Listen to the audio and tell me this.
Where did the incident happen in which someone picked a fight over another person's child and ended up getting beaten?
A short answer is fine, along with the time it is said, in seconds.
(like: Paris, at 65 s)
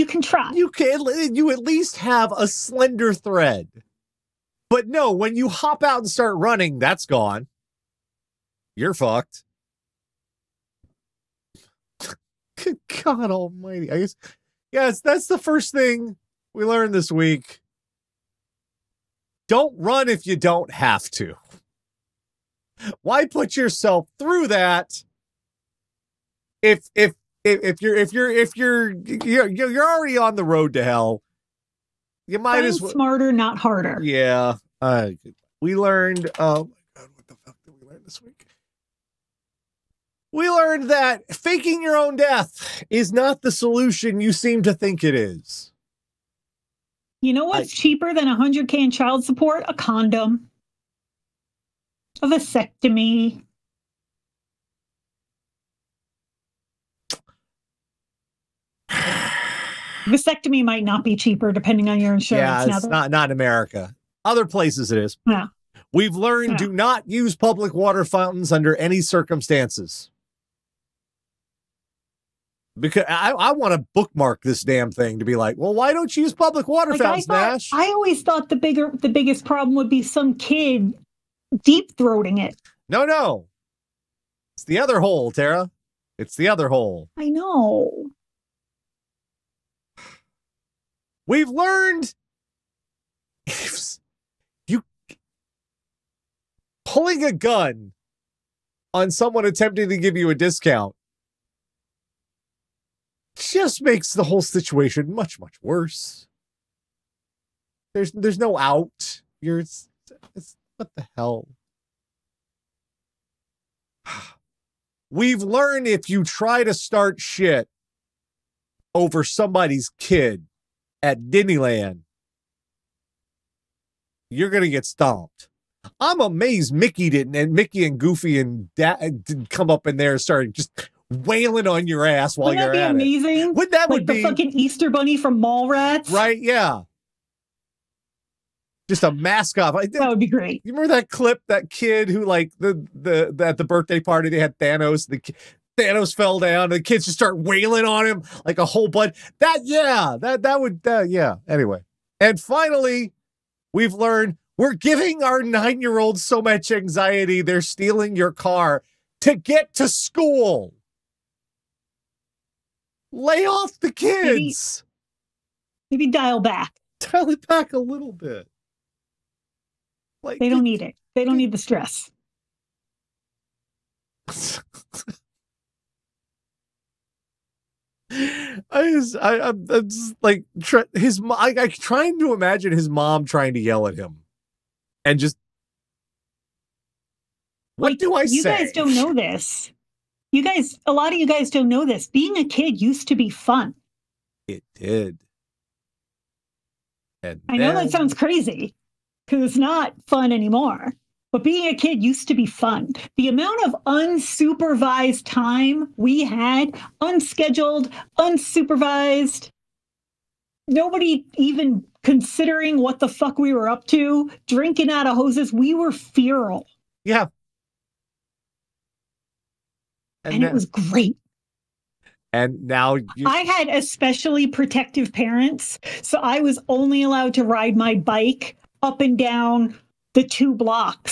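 Disneyland, at 121 s.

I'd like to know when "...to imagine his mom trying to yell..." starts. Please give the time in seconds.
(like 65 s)
182 s.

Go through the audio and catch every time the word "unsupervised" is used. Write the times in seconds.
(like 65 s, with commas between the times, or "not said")
203 s, 208 s.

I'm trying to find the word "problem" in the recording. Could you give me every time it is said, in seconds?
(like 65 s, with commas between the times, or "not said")
79 s.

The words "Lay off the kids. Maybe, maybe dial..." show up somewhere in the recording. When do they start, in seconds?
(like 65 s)
163 s.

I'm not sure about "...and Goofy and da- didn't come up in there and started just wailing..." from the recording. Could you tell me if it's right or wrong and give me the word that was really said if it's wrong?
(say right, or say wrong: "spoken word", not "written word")
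right.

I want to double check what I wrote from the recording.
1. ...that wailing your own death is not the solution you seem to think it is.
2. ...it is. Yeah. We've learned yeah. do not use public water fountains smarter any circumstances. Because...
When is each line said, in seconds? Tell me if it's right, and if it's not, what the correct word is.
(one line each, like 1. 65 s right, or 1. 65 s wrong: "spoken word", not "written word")
1. 40 s wrong: "faking", not "wailing"
2. 64 s wrong: "under", not "smarter".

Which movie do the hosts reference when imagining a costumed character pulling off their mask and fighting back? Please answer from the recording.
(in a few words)
Mallrats.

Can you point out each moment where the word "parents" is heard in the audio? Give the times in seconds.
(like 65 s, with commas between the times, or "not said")
225 s.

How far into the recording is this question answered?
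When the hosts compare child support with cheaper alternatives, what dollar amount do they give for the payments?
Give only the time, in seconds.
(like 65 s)
48 s.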